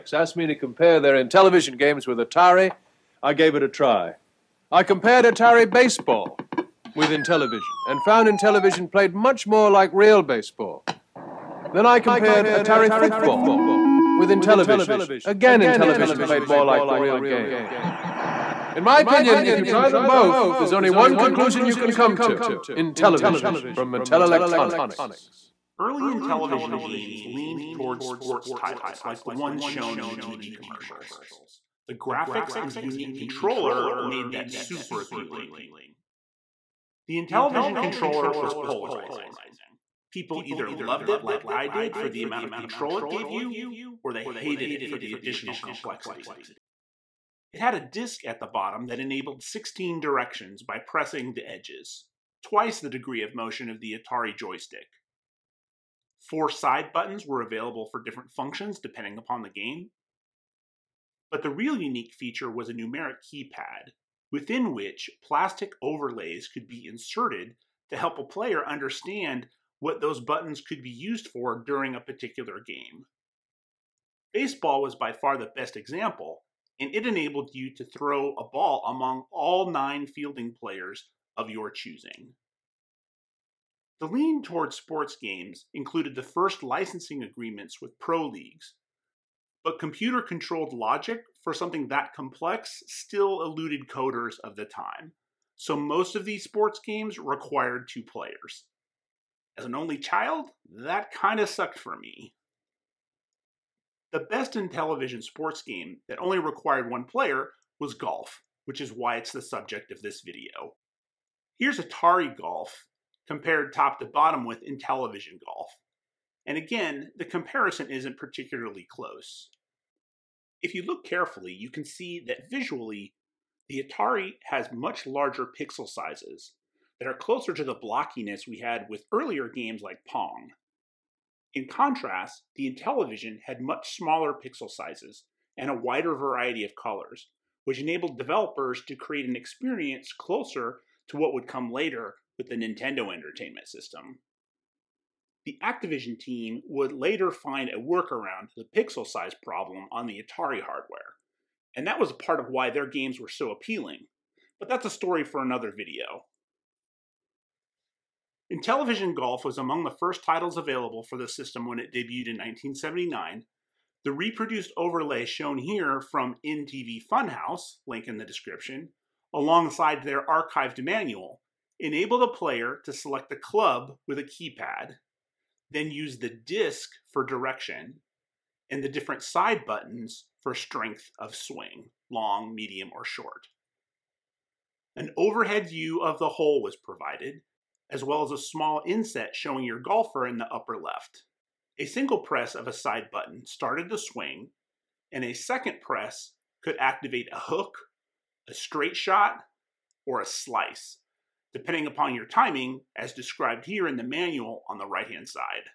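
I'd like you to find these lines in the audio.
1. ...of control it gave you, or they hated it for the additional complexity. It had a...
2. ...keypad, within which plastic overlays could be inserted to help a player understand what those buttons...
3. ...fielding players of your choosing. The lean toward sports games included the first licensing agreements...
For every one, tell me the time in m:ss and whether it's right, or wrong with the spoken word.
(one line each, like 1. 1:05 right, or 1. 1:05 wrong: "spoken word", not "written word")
1. 0:42 right
2. 1:03 right
3. 1:20 right.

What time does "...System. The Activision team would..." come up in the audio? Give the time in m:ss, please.
2:23.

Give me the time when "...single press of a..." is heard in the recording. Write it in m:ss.
3:11.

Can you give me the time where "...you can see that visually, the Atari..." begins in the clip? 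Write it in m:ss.
2:01.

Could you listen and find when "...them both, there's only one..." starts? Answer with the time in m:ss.
0:19.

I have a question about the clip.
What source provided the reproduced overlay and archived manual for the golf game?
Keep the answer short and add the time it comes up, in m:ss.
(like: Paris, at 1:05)
InTV Funhouse, at 2:46.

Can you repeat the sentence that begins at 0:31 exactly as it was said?
The graphics and unique controller made that super appealing.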